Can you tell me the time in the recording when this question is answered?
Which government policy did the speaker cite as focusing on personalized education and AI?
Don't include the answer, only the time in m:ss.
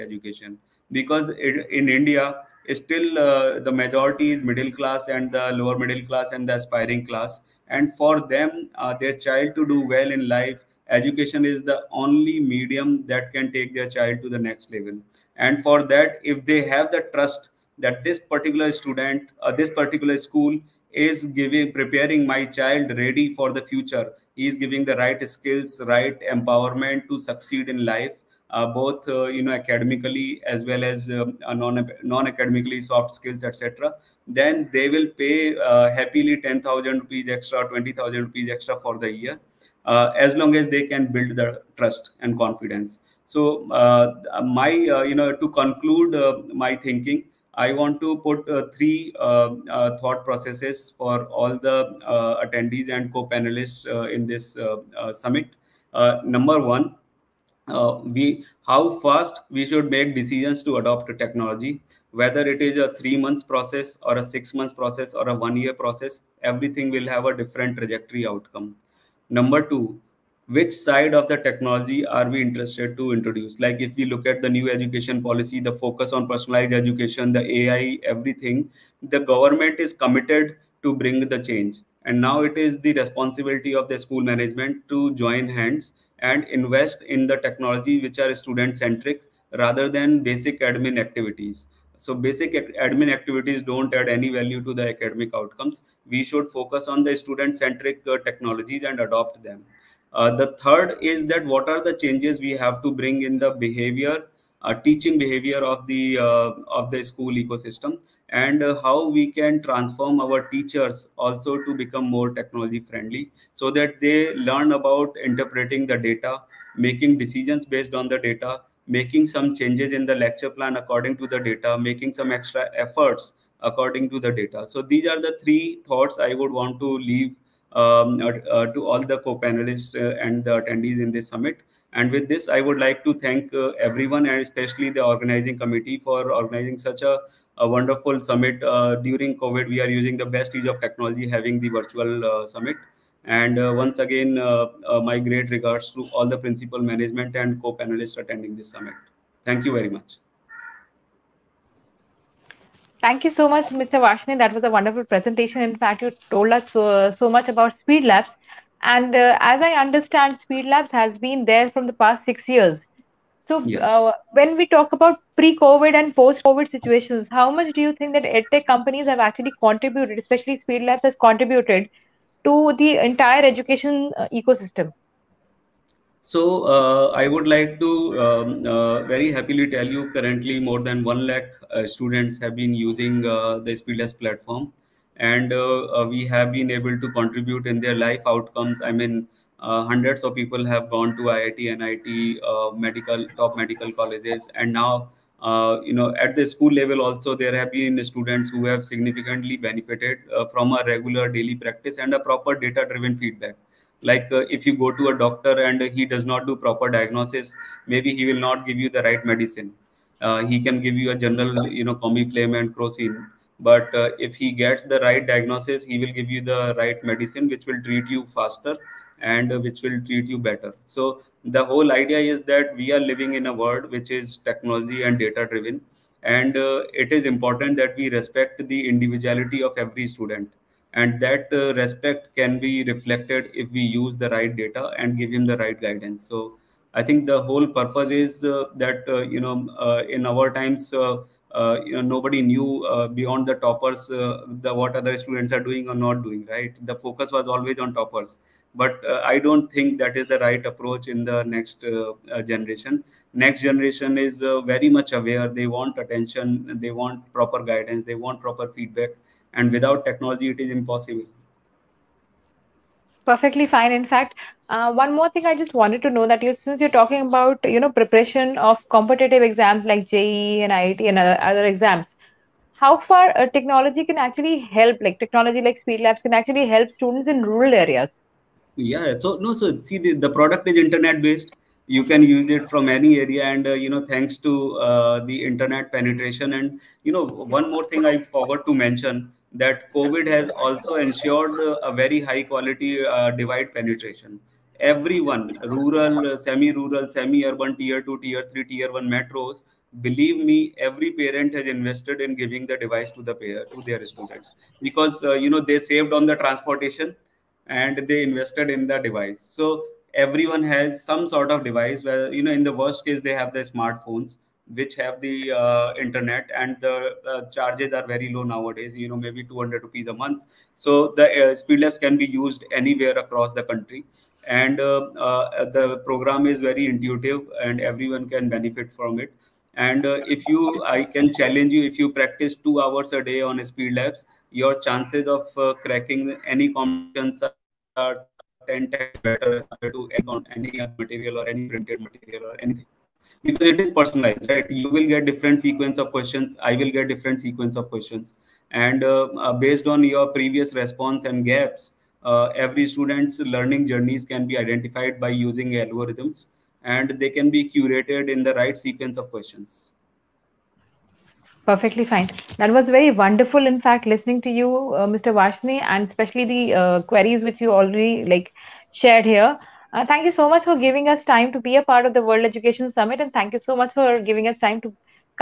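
1:14.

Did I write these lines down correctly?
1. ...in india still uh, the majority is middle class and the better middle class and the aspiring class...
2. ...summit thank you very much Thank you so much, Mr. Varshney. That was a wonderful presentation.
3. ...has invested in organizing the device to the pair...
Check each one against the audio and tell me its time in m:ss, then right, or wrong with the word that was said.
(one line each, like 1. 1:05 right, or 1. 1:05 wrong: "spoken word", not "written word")
1. 0:01 wrong: "lower", not "better"
2. 2:28 right
3. 5:01 wrong: "giving", not "organizing".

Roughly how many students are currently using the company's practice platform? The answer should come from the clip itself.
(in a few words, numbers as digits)
more than 1 lakh.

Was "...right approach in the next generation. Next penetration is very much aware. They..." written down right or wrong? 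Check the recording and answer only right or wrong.
wrong.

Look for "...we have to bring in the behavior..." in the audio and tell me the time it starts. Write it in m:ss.
1:42.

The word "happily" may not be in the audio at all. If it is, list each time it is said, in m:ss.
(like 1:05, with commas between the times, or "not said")
0:35, 2:59.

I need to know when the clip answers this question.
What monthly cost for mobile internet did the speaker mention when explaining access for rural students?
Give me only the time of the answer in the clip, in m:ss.
5:19.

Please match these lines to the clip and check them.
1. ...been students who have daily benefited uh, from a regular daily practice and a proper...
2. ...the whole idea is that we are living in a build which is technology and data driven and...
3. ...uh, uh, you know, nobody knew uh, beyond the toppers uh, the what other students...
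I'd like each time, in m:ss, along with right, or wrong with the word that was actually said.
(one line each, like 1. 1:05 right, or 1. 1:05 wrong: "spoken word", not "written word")
1. 3:17 wrong: "significantly", not "daily"
2. 3:41 wrong: "world", not "build"
3. 4:00 right.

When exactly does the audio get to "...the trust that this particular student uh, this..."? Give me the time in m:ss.
0:16.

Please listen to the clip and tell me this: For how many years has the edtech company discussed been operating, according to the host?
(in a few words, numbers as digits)
6 years.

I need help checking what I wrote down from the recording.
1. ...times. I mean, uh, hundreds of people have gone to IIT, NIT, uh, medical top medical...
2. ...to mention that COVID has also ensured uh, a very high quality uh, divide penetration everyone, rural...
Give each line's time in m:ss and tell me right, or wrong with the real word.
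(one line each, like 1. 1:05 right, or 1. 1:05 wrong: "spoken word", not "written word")
1. 3:08 wrong: "outcomes", not "times"
2. 4:48 right.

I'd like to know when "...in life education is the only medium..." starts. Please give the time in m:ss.
0:10.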